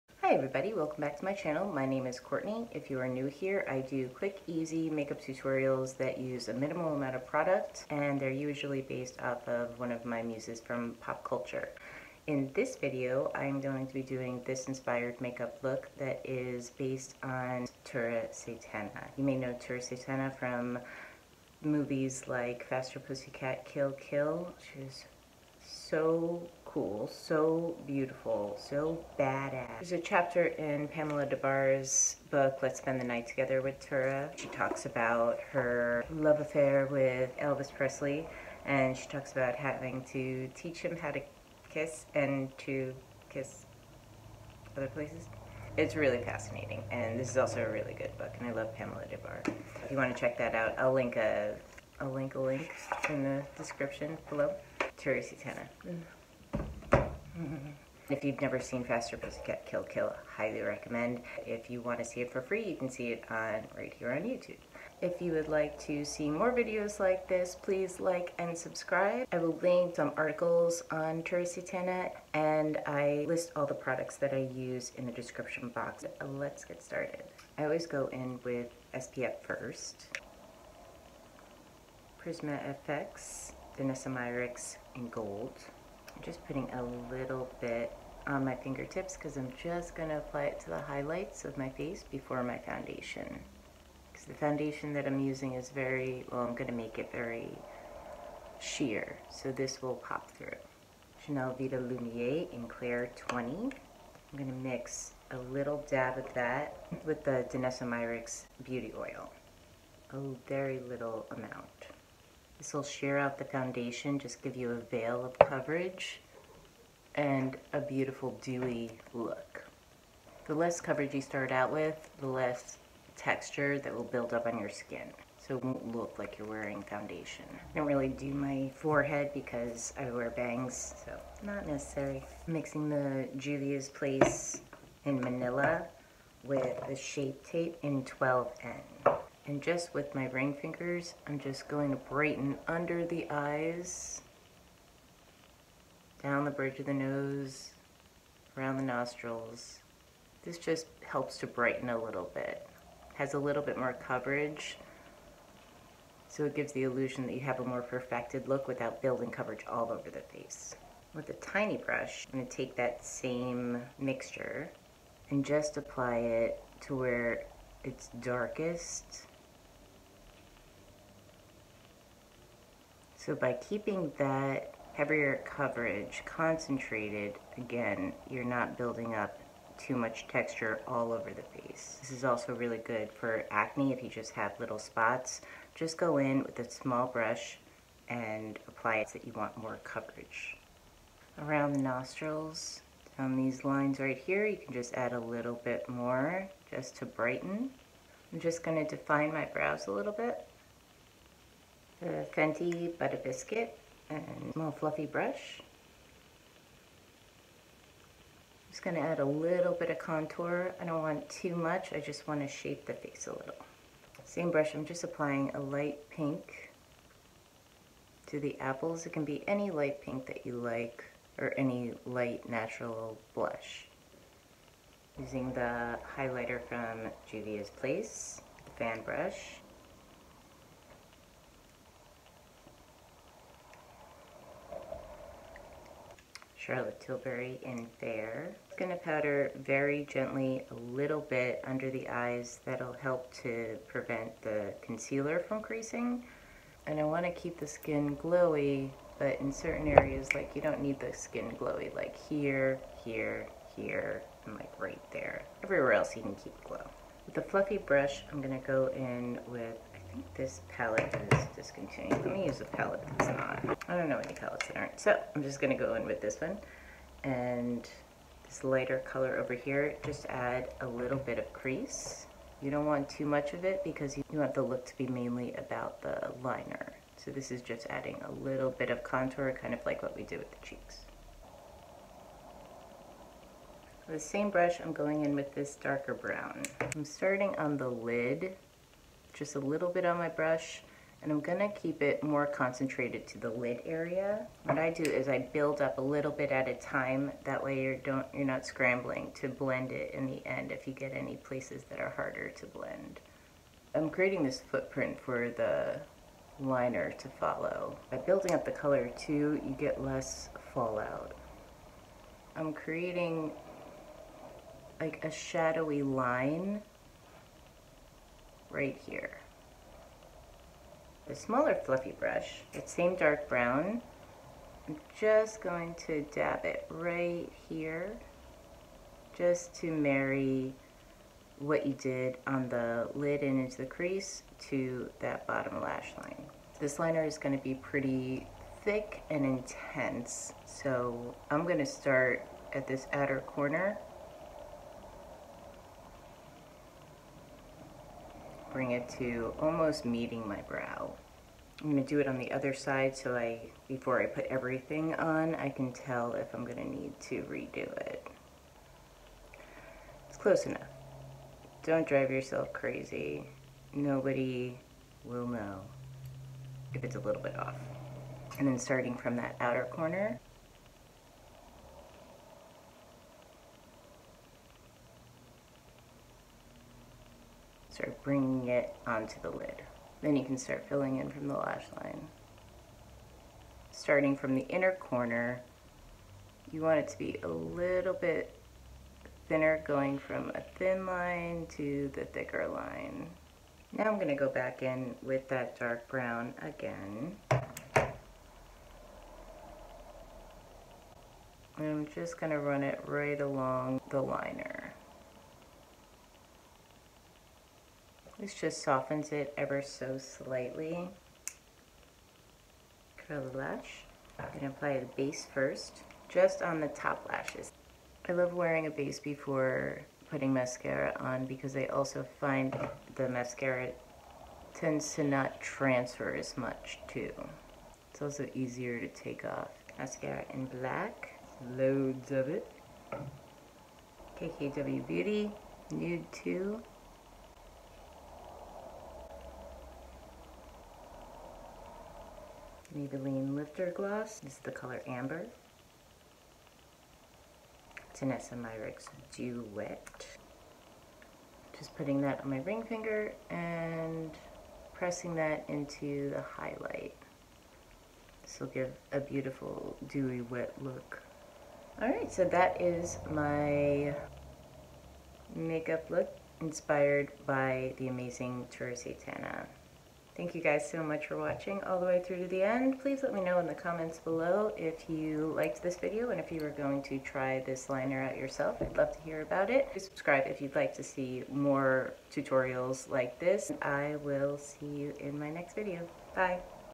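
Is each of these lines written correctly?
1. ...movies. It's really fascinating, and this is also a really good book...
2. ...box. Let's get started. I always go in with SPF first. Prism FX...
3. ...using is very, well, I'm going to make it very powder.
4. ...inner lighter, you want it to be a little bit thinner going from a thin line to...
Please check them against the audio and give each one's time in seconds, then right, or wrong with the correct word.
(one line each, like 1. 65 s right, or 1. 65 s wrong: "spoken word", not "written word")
1. 44 s wrong: "places", not "movies"
2. 75 s right
3. 95 s wrong: "sheer", not "powder"
4. 384 s wrong: "corner", not "lighter".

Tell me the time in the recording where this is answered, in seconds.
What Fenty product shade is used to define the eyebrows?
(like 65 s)
202 s.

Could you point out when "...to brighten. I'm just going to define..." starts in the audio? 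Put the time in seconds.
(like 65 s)
196 s.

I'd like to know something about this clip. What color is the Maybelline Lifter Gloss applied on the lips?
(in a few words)
Amber.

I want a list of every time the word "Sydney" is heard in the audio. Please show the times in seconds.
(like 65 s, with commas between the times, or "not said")
not said.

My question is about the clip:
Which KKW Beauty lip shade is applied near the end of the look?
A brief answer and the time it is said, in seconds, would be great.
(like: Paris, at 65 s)
Nude 2, at 435 s.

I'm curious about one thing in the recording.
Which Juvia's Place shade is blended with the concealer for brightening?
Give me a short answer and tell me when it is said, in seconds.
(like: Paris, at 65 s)
Manila, at 135 s.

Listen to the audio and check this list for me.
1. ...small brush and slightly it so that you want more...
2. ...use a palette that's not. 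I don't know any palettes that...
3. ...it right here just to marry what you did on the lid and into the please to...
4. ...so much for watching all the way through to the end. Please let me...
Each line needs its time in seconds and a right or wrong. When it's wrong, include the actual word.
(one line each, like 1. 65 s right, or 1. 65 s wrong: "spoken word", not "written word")
1. 186 s wrong: "apply", not "slightly"
2. 262 s right
3. 326 s wrong: "crease", not "please"
4. 470 s right.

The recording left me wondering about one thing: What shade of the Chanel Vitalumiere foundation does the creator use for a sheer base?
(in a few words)
Clair 20.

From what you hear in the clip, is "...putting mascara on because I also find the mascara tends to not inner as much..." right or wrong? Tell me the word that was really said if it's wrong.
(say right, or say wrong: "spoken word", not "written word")
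wrong: "transfer", not "inner".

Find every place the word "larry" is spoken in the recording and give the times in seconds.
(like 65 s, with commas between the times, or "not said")
not said.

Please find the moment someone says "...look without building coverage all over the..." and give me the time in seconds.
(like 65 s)
158 s.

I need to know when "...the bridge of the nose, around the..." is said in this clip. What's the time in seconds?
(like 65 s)
146 s.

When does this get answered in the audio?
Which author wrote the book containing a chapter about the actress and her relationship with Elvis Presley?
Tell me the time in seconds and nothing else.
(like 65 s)
30 s.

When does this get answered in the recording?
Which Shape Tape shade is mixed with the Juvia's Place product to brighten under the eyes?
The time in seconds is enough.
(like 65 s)
138 s.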